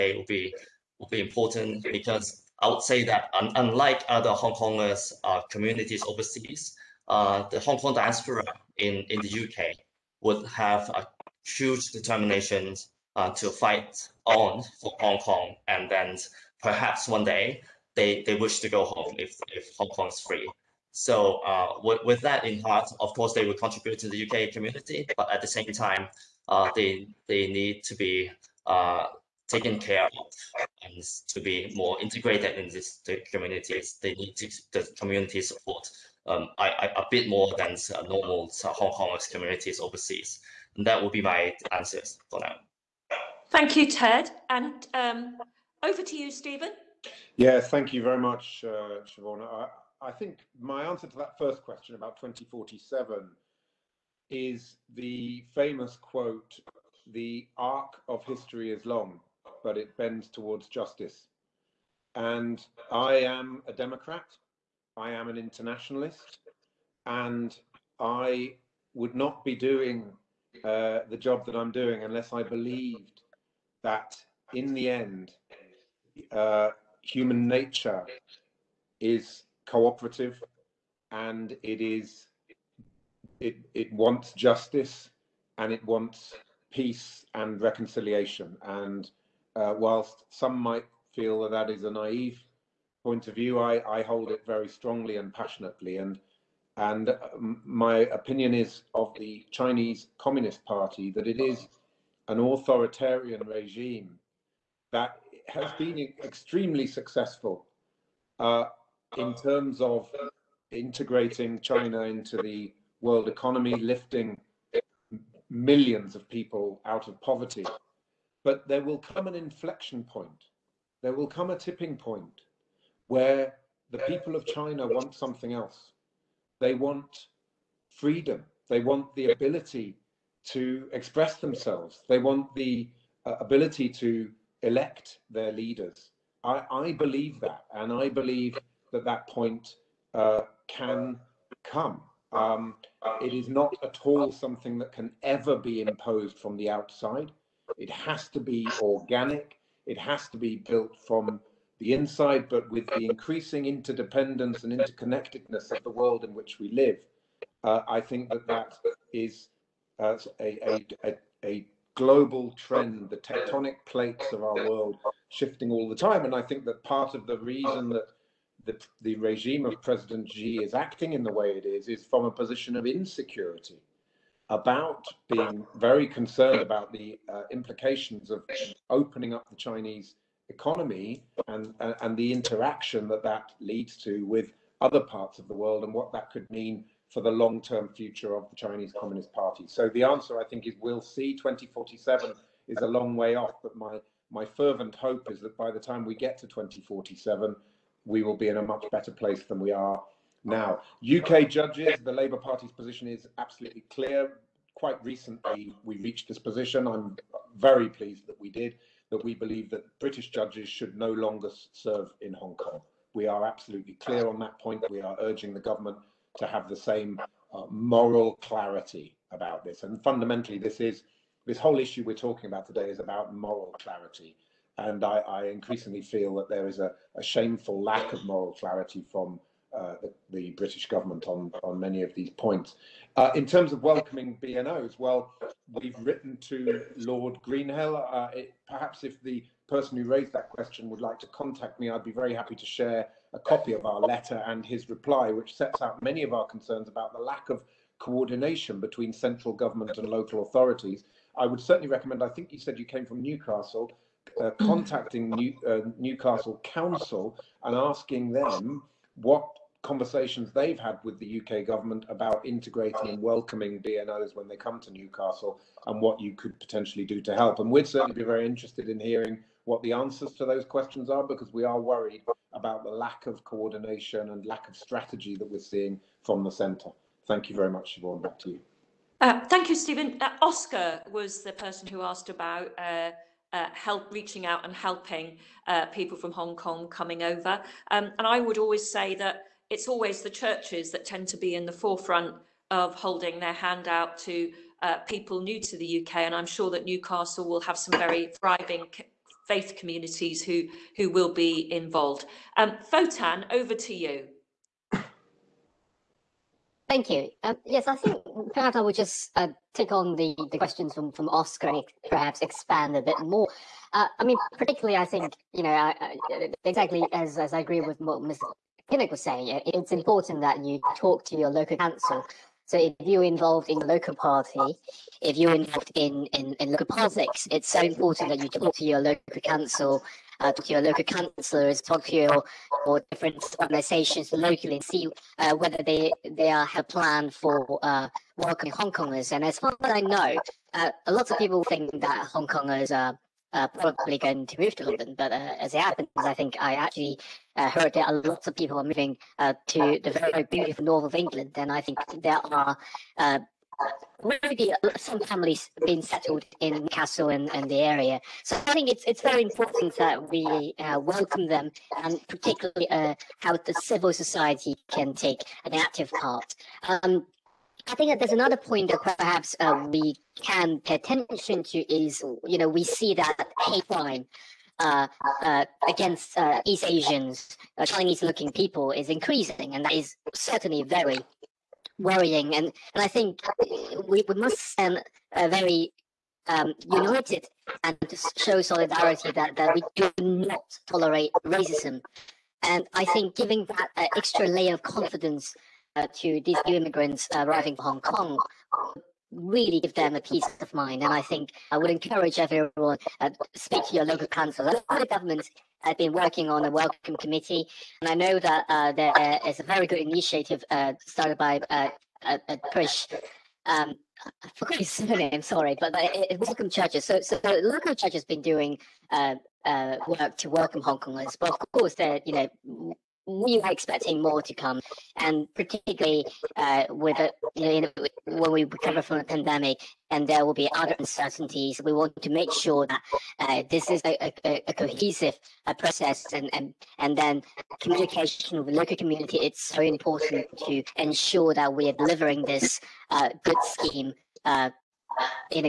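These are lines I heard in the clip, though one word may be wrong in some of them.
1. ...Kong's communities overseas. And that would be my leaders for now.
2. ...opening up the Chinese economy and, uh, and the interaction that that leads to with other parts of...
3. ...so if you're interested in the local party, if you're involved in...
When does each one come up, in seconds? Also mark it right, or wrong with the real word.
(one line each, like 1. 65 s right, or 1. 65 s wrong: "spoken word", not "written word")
1. 38 s wrong: "answers", not "leaders"
2. 178 s right
3. 322 s wrong: "involved", not "interested".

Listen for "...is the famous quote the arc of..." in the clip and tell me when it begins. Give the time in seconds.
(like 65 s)
54 s.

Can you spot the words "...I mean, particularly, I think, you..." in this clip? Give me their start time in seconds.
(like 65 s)
314 s.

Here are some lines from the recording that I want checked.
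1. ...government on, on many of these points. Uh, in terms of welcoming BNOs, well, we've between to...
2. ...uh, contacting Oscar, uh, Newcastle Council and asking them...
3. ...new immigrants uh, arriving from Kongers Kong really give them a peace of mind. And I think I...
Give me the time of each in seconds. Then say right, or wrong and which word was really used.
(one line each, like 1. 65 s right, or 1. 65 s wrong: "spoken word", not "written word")
1. 230 s wrong: "written", not "between"
2. 254 s wrong: "New", not "Oscar"
3. 396 s wrong: "Hong", not "Kongers".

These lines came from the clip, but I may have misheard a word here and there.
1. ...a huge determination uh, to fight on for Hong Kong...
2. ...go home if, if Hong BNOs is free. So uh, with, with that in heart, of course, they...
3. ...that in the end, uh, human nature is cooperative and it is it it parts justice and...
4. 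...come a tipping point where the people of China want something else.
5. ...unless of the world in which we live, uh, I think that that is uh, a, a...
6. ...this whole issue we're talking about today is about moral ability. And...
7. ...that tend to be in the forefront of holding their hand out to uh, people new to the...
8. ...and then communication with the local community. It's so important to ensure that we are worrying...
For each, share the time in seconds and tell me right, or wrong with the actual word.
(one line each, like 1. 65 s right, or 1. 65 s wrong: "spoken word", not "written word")
1. 10 s right
2. 18 s wrong: "Kong", not "BNOs"
3. 73 s wrong: "wants", not "parts"
4. 121 s right
5. 154 s wrong: "interconnectedness", not "unless"
6. 221 s wrong: "clarity", not "ability"
7. 290 s right
8. 436 s wrong: "delivering", not "worrying".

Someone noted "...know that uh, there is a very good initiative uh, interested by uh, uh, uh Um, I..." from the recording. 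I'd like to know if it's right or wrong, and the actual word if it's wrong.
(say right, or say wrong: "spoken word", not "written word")
wrong: "started", not "interested".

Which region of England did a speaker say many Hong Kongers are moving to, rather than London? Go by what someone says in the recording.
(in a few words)
north of England.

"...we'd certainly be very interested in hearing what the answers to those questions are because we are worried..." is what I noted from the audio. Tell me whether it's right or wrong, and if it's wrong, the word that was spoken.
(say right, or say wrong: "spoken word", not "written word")
right.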